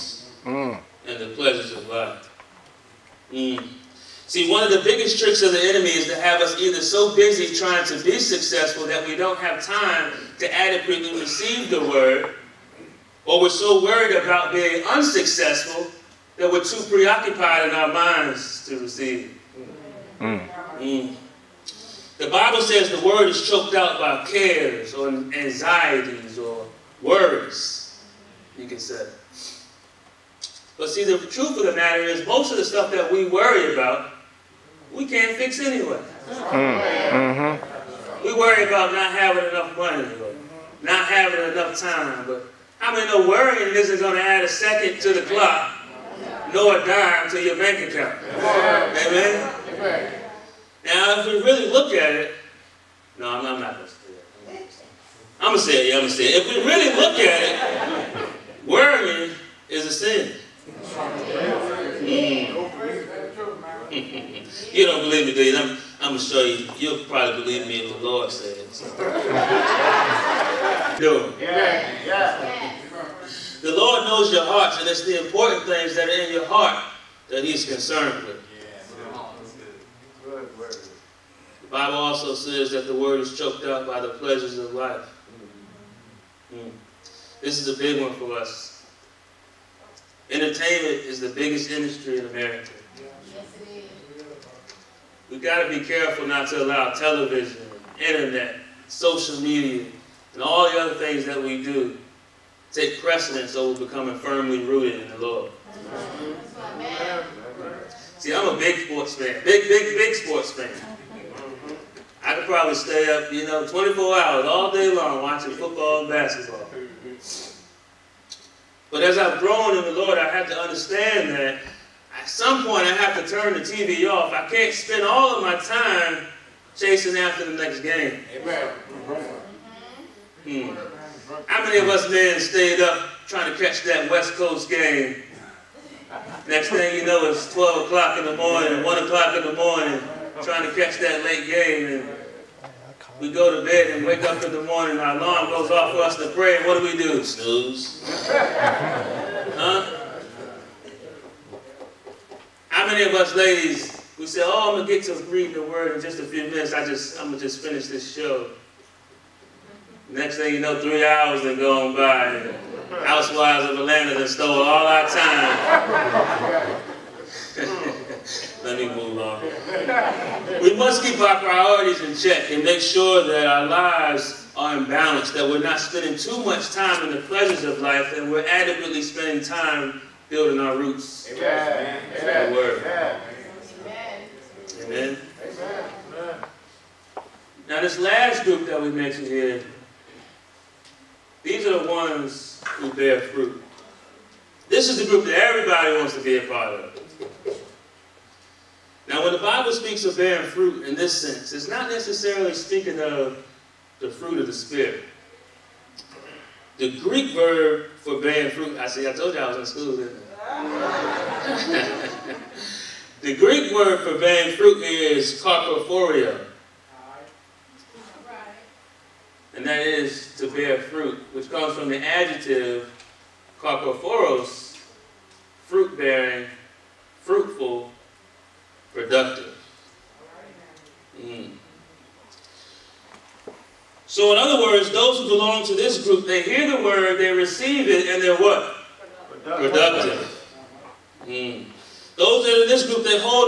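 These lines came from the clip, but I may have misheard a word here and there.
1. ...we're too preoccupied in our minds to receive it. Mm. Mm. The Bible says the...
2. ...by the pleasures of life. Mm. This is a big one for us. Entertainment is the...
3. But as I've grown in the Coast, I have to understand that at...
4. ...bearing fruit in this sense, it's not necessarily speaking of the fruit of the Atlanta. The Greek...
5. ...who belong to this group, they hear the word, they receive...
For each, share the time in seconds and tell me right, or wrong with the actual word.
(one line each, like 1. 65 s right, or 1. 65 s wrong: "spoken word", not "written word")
1. 16 s right
2. 83 s right
3. 118 s wrong: "Lord", not "Coast"
4. 200 s wrong: "Spirit", not "Atlanta"
5. 235 s right.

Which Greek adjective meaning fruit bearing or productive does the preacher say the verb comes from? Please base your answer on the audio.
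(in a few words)
carpophoros.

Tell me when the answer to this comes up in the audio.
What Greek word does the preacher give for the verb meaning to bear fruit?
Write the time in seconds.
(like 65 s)
215 s.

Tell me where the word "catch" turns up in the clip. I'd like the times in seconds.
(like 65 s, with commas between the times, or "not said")
133 s, 140 s.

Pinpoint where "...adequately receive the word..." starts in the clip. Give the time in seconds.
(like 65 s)
10 s.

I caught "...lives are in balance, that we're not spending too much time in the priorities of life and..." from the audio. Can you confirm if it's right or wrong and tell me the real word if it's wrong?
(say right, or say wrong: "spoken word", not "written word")
wrong: "pleasures", not "priorities".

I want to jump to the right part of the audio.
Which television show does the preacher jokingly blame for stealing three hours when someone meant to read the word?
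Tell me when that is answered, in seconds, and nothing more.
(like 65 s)
163 s.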